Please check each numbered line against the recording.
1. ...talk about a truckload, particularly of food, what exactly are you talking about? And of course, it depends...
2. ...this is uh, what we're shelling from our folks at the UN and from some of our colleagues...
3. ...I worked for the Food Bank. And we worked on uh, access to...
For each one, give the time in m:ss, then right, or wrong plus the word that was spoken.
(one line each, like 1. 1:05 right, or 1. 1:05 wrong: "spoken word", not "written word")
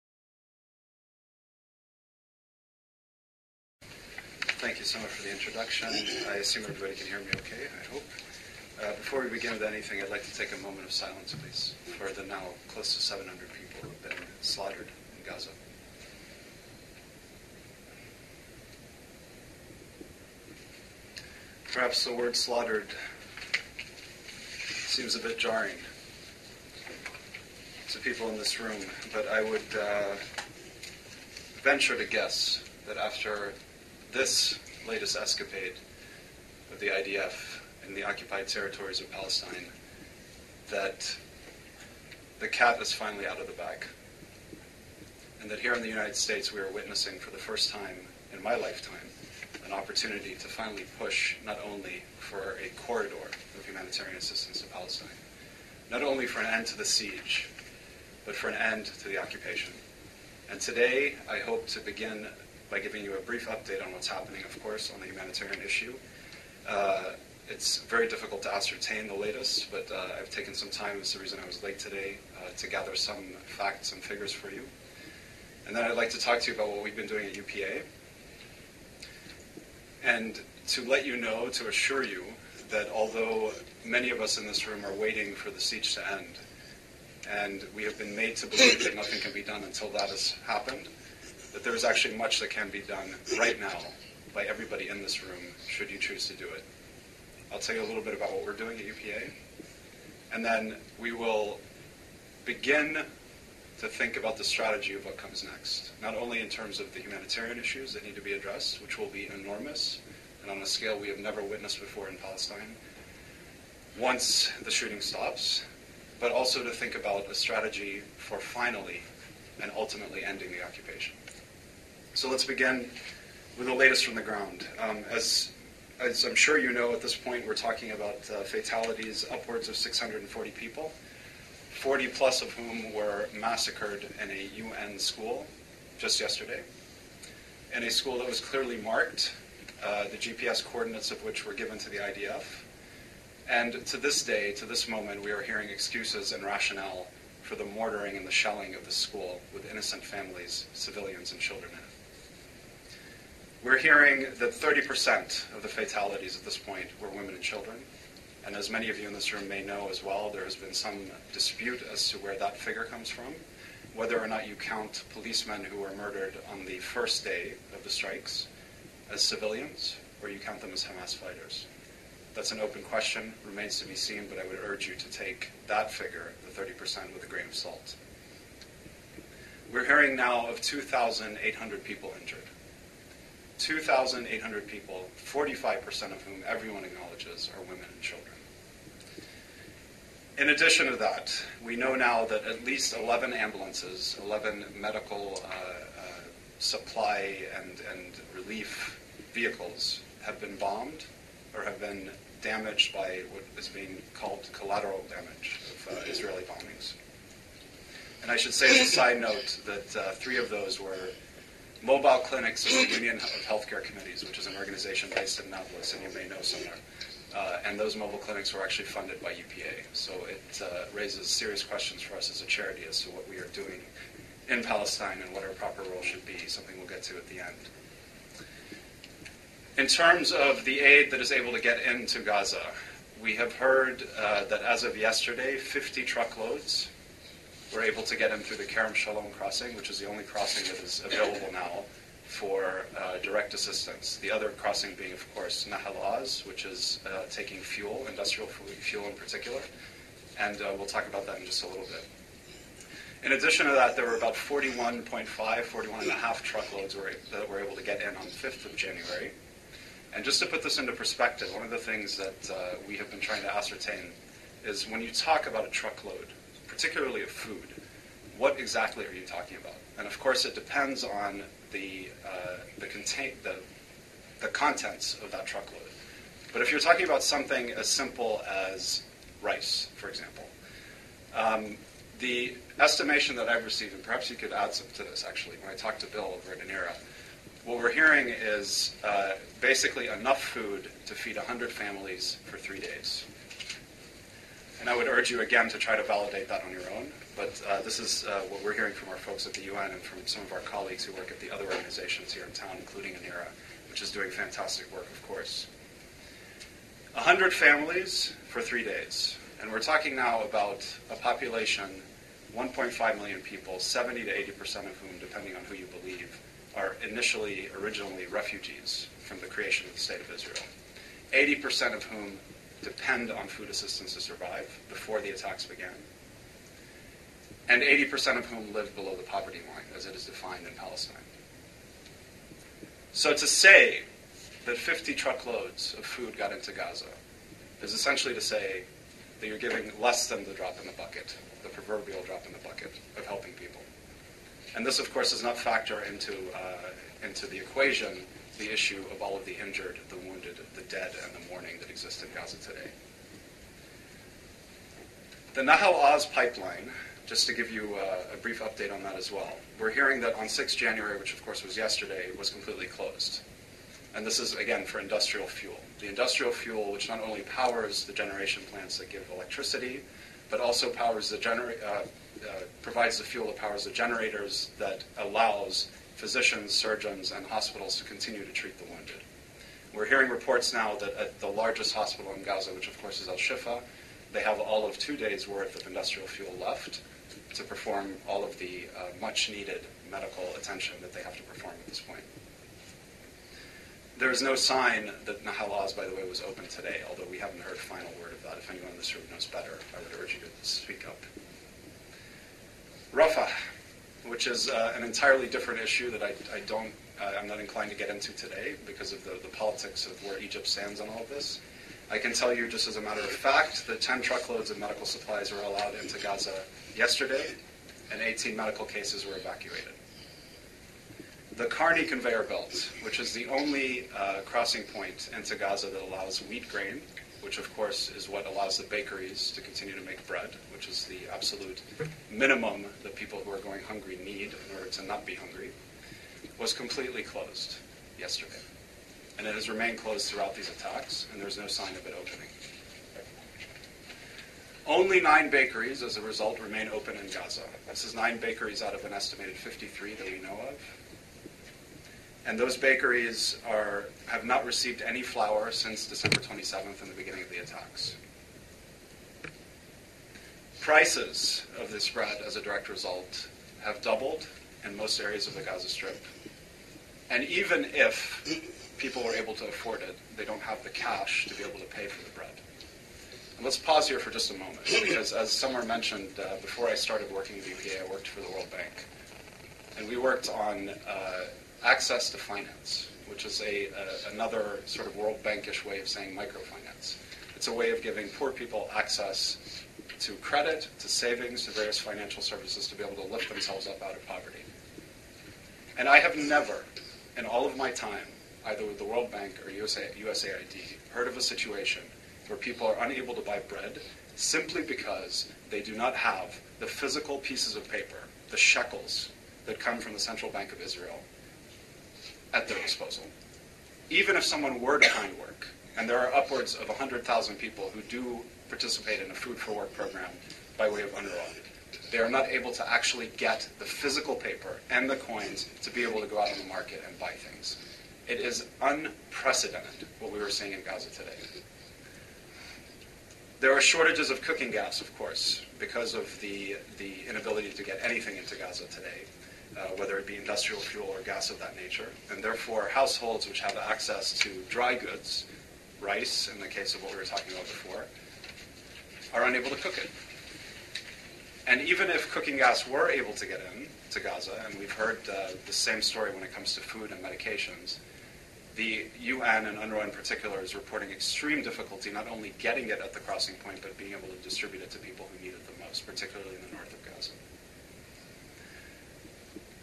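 1. 4:25 right
2. 4:57 wrong: "hearing", not "shelling"
3. 7:58 wrong: "World", not "Food".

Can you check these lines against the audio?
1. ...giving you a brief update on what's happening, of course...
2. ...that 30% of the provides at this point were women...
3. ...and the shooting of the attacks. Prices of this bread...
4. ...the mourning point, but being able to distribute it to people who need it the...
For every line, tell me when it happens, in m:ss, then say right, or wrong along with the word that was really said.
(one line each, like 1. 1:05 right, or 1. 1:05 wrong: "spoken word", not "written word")
1. 1:02 right
2. 2:34 wrong: "fatalities", not "provides"
3. 7:37 wrong: "beginning", not "shooting"
4. 9:23 wrong: "crossing", not "mourning".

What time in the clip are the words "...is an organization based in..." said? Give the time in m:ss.
3:34.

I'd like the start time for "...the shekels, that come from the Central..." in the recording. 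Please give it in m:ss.
8:28.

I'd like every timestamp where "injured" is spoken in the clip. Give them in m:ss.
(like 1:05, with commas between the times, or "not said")
3:02, 5:49.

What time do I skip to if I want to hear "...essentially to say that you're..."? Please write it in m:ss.
5:37.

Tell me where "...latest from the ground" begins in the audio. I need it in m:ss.
2:03.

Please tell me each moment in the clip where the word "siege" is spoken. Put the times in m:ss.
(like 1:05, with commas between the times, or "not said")
0:56, 1:25.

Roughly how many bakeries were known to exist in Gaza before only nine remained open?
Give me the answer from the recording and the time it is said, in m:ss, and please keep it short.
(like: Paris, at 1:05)
53, at 7:29.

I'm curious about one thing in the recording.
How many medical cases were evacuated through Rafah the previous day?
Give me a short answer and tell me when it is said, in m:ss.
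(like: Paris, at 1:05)
18, at 6:58.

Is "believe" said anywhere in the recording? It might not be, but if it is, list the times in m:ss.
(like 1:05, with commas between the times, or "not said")
1:28, 5:16.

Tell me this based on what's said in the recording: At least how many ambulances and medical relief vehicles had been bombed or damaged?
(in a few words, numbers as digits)
11.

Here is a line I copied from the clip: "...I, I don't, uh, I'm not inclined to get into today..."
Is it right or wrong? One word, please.
right.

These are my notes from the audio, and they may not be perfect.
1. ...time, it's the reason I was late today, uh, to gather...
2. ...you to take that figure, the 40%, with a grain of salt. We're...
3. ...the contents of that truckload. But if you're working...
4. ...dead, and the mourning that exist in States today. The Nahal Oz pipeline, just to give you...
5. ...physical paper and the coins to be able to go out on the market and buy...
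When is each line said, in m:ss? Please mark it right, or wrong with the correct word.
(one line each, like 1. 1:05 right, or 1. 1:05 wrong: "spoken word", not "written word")
1. 1:10 right
2. 2:54 wrong: "30", not "40"
3. 4:34 wrong: "talking", not "working"
4. 5:50 wrong: "Gaza", not "States"
5. 8:43 right.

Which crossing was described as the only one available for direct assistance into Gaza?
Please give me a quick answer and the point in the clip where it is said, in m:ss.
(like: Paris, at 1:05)
Kerem Shalom, at 3:58.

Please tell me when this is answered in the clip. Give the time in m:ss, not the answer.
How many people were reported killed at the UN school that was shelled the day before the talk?
2:11.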